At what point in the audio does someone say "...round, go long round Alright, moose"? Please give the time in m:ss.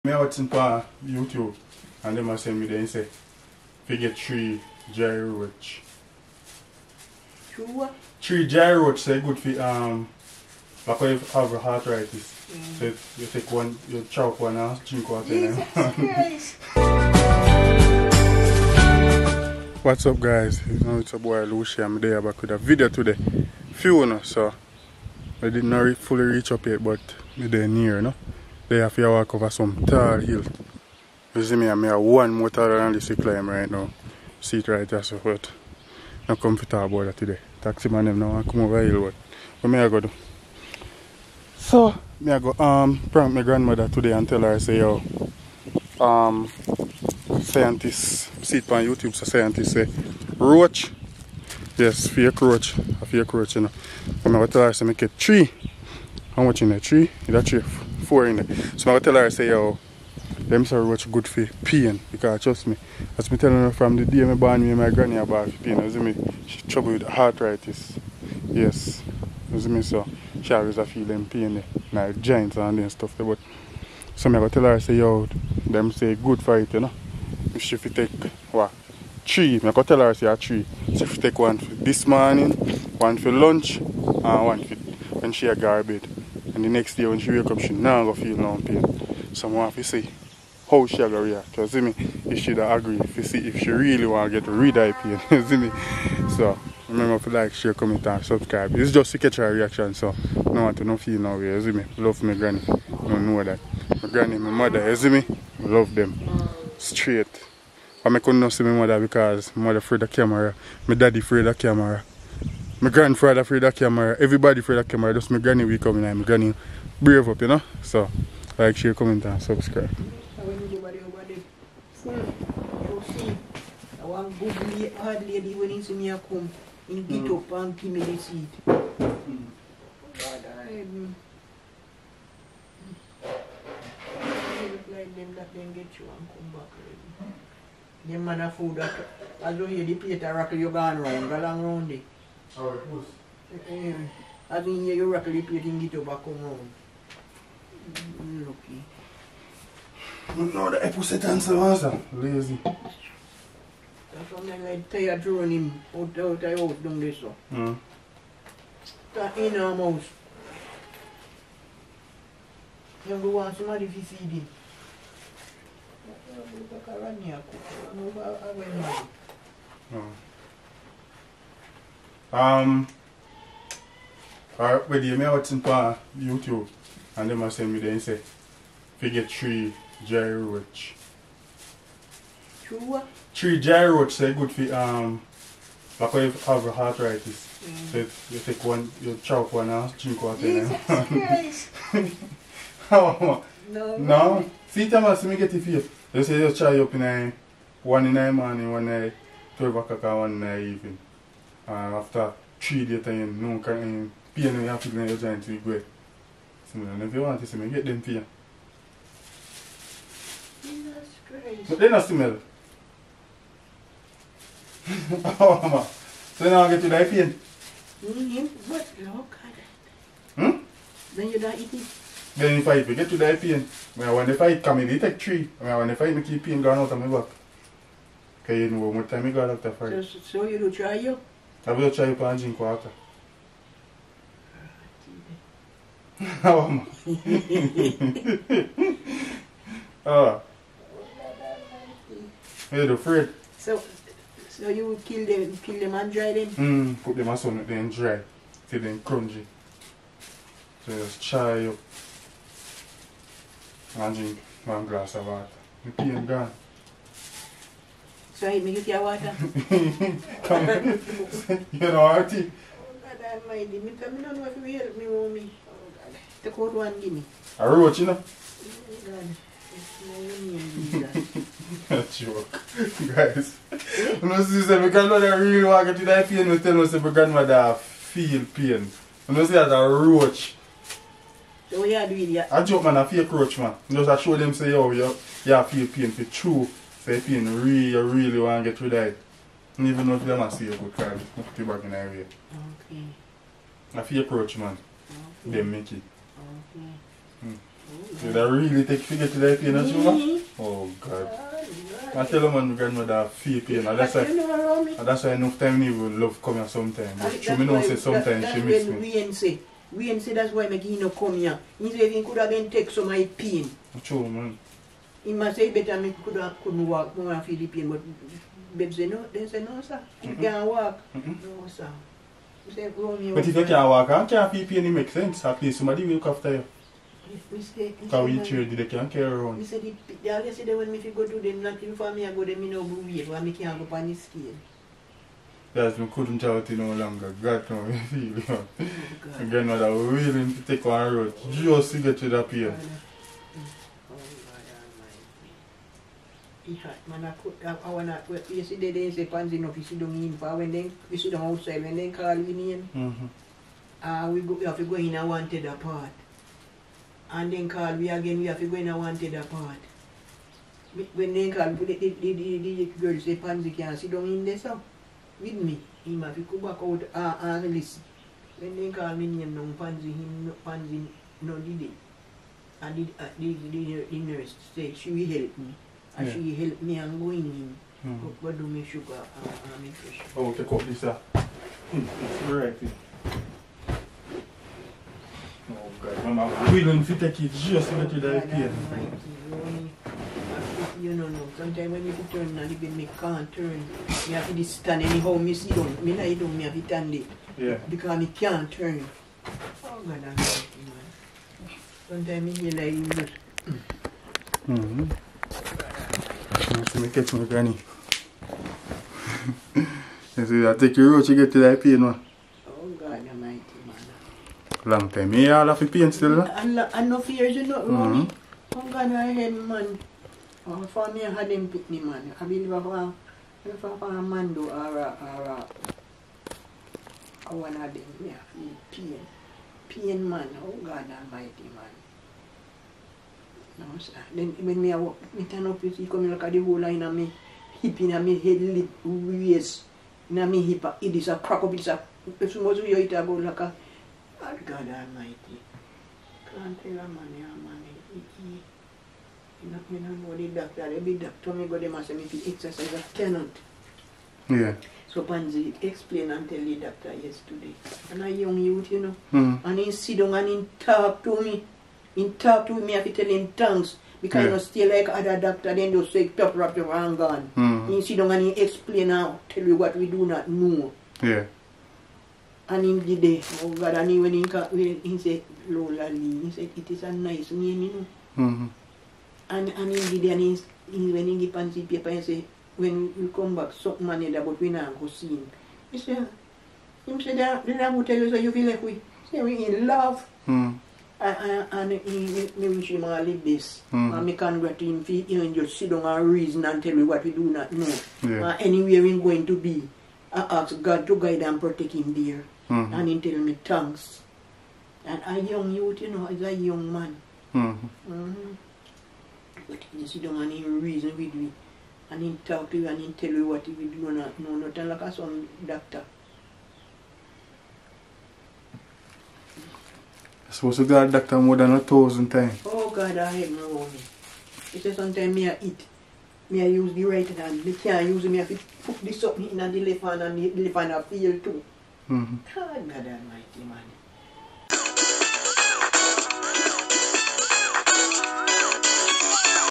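2:20.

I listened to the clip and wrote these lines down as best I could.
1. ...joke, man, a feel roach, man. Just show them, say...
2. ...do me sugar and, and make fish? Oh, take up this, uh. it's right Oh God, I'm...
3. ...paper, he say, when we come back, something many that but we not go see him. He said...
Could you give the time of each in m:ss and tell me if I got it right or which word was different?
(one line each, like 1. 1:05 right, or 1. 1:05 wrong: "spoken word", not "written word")
1. 4:42 right
2. 6:18 right
3. 8:01 right.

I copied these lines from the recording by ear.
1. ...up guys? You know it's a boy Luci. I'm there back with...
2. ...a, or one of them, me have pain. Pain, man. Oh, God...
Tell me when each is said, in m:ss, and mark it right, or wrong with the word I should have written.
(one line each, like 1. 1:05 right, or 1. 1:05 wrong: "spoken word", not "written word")
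1. 0:20 right
2. 7:05 right.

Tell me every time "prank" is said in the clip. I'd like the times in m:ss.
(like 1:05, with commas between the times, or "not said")
0:43.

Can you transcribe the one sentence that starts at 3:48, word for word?
Because you know, what time you got after fight.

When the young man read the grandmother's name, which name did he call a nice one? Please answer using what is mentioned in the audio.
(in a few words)
Lola Lee.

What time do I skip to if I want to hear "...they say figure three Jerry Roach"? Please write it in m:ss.
0:02.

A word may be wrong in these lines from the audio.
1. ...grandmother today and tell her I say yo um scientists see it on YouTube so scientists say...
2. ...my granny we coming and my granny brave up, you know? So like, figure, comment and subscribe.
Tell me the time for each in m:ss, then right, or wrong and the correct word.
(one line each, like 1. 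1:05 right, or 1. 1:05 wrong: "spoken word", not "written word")
1. 0:43 right
2. 1:55 wrong: "share", not "figure".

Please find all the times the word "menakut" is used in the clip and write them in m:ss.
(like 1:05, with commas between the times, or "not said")
5:47.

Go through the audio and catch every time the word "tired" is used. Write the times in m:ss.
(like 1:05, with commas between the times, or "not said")
2:34.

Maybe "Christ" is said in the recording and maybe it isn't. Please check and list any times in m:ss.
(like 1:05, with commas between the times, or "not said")
3:10, 3:31.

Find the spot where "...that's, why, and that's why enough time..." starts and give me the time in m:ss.
5:03.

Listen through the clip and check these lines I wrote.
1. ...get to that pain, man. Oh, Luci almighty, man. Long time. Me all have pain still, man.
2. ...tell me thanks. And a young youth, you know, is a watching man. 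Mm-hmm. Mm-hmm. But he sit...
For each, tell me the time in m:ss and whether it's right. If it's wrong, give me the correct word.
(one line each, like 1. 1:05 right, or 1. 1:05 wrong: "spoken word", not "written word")
1. 6:51 wrong: "God", not "Luci"
2. 8:23 wrong: "young", not "watching".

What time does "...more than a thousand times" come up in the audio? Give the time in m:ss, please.
8:41.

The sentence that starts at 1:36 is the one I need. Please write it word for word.
So remember to like, share, comment, and subscribe.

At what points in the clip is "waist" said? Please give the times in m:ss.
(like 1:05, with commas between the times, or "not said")
7:19.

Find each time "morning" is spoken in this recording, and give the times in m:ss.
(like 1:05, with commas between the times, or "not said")
1:22, 3:18.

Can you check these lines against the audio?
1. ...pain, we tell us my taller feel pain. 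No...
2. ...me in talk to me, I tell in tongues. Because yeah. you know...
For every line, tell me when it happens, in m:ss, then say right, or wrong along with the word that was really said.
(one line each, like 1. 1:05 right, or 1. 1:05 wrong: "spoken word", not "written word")
1. 4:36 wrong: "grandmother", not "taller"
2. 7:41 right.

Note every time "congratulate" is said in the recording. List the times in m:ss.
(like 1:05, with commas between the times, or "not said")
8:14.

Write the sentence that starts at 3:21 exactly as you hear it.
And after three days time, no can pain you have to your joint to go.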